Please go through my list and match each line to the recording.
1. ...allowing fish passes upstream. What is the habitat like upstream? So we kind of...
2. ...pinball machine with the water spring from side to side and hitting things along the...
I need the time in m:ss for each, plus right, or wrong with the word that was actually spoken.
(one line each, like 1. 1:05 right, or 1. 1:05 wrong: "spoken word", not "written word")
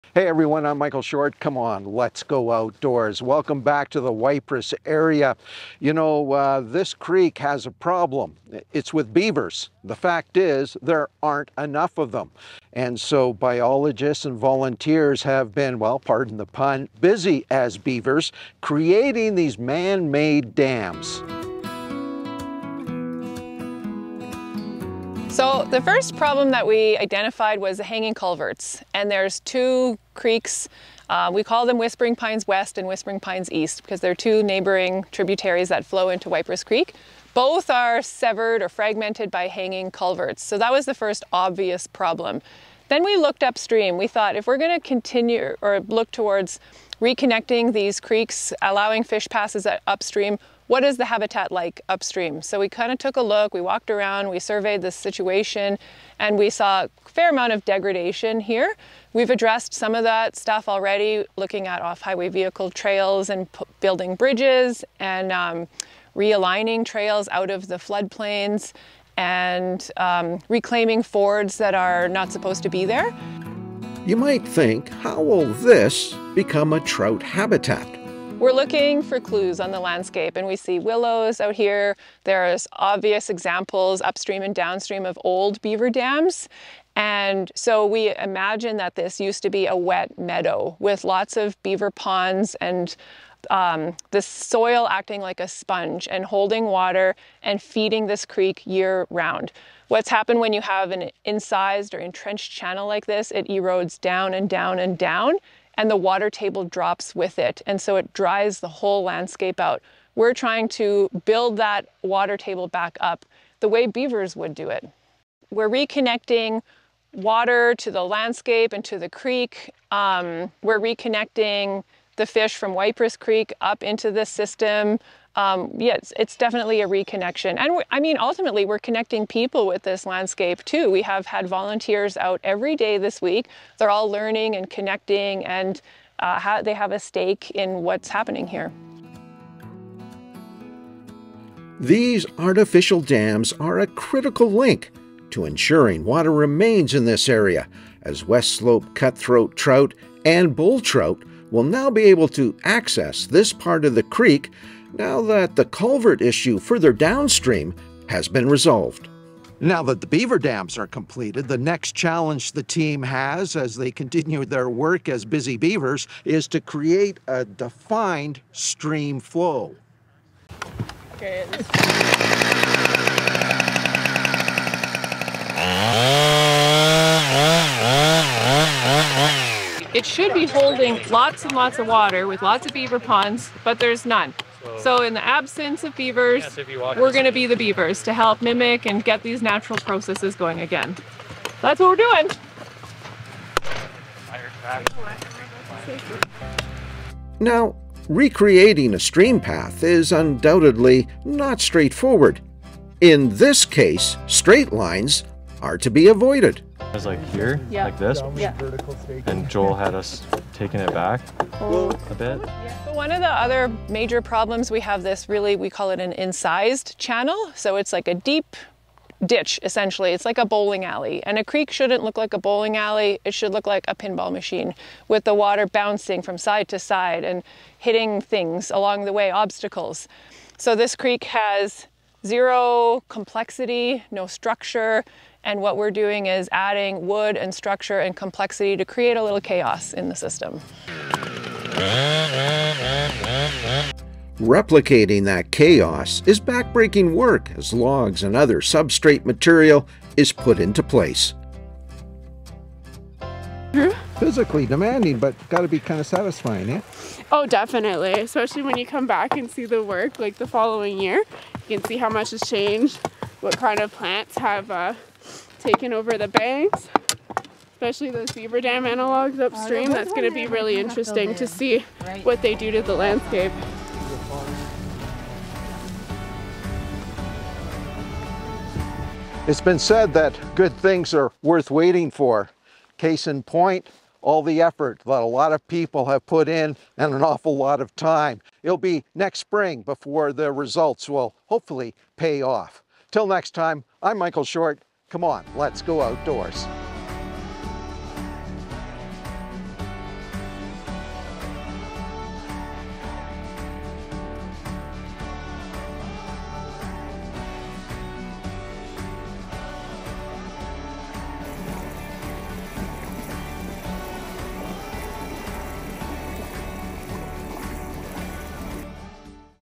1. 0:48 right
2. 3:43 wrong: "bouncing", not "spring".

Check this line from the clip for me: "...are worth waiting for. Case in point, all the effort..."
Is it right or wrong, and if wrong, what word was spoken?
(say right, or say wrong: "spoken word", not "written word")
right.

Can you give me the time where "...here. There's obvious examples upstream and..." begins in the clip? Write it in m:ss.
1:21.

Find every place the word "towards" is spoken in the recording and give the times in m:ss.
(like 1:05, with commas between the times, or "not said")
0:46.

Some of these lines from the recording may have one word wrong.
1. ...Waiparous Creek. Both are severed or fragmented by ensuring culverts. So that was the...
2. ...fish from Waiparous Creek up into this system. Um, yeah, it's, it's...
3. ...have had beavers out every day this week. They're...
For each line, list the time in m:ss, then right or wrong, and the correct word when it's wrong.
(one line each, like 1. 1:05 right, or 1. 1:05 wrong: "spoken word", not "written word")
1. 0:36 wrong: "hanging", not "ensuring"
2. 2:02 right
3. 2:11 wrong: "volunteers", not "beavers".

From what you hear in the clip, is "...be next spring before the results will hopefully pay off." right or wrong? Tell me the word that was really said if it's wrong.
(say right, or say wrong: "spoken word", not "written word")
right.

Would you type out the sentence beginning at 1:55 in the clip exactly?
We're reconnecting water to the landscape and to the creek.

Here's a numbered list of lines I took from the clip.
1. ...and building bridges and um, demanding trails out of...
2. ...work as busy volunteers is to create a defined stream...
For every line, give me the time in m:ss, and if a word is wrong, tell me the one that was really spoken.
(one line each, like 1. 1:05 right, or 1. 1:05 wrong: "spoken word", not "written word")
1. 1:03 wrong: "realigning", not "demanding"
2. 2:44 wrong: "beavers", not "volunteers".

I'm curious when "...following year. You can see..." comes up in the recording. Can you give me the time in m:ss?
4:20.